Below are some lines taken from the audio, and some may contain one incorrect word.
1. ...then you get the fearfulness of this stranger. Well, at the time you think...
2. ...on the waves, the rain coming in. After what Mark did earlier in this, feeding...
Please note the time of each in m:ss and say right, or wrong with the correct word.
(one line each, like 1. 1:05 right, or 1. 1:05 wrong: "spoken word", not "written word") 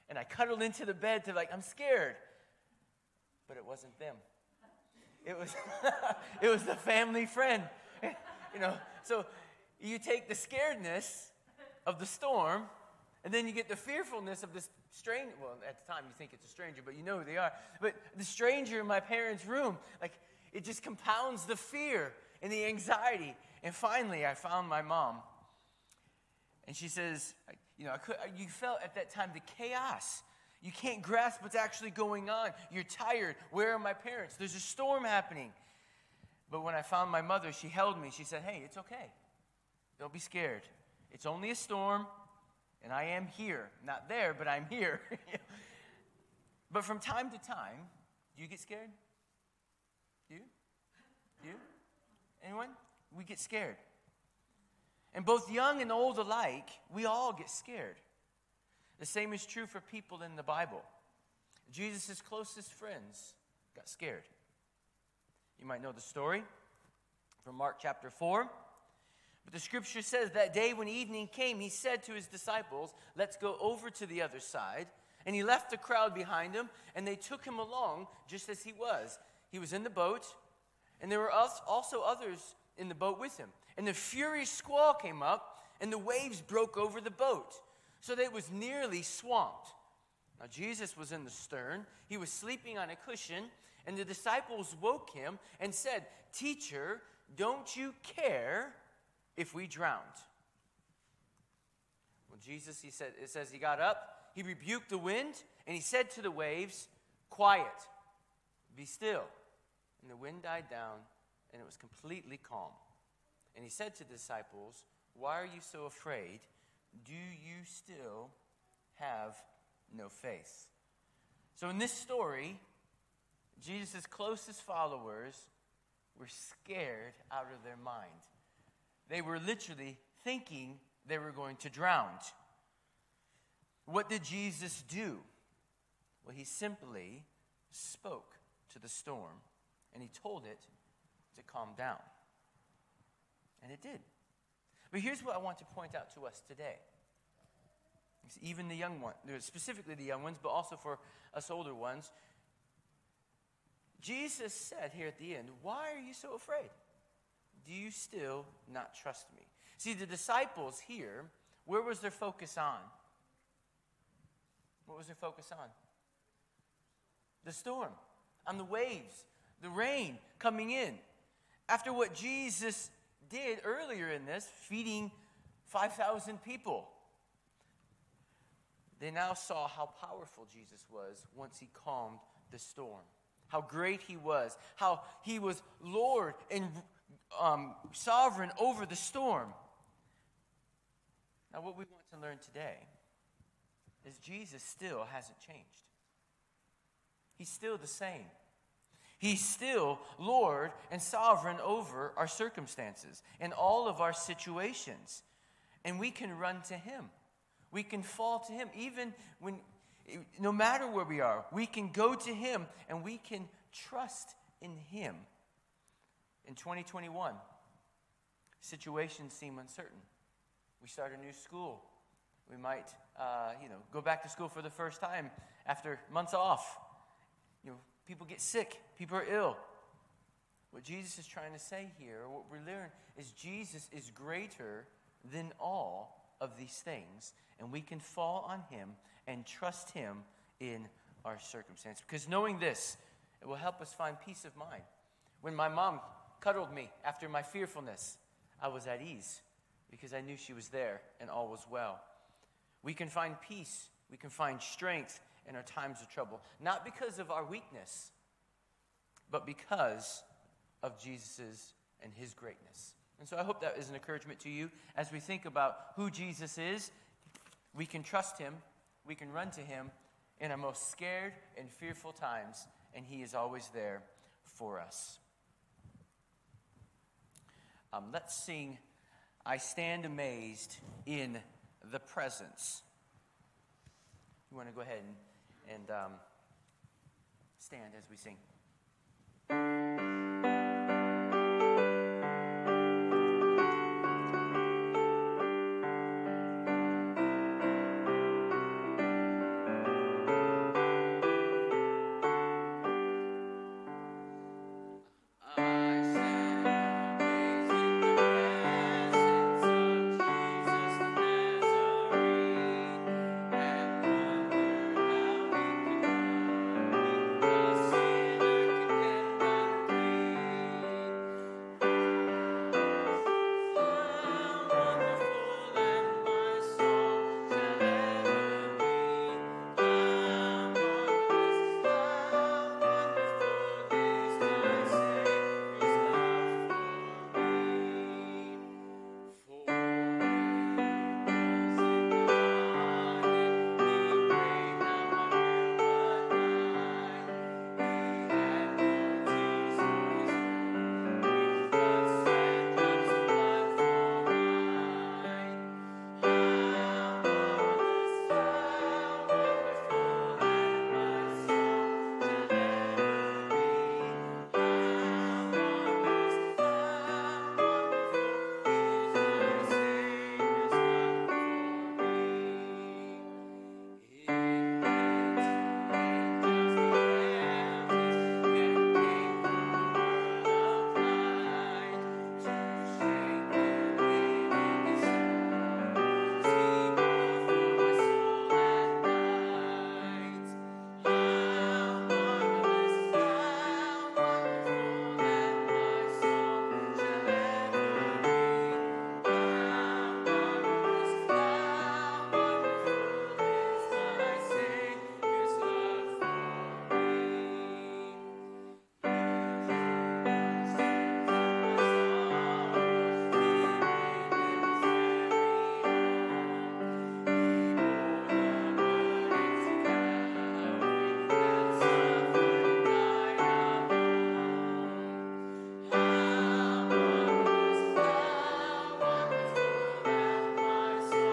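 1. 0:13 right
2. 2:48 wrong: "Jesus", not "Mark".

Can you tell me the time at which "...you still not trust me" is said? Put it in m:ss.
2:37.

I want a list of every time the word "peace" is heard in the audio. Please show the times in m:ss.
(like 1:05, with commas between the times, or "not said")
4:04, 4:13.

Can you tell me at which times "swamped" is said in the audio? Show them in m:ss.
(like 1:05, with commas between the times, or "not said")
1:29.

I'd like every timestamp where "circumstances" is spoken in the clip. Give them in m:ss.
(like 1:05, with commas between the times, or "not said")
3:22, 4:01.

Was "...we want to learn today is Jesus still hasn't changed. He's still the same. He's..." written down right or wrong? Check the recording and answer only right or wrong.
right.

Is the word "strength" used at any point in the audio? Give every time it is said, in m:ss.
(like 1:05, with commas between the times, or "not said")
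4:14.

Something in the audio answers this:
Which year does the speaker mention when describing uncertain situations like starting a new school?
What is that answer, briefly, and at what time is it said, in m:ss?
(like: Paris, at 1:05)
2021, at 3:36.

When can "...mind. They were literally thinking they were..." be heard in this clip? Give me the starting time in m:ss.
2:07.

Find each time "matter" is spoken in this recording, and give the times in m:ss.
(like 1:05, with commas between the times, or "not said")
3:30.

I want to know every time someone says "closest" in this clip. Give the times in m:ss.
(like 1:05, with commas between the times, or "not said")
1:02, 2:04.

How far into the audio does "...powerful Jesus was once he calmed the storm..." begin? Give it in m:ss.
3:00.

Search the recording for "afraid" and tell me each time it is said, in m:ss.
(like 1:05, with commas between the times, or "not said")
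1:55, 2:36.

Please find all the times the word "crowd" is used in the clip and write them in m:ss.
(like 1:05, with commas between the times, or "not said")
1:15.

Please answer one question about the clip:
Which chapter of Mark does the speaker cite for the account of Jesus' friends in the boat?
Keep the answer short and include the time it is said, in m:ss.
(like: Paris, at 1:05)
Mark chapter 4, at 1:07.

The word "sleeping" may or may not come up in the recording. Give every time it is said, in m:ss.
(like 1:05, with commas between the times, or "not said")
1:32.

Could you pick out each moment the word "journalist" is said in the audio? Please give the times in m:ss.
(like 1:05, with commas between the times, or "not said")
not said.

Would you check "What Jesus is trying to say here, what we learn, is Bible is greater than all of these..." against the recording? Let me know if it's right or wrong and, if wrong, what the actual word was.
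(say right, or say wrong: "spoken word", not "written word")
wrong: "Jesus", not "Bible".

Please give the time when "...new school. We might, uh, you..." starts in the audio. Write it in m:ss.
3:41.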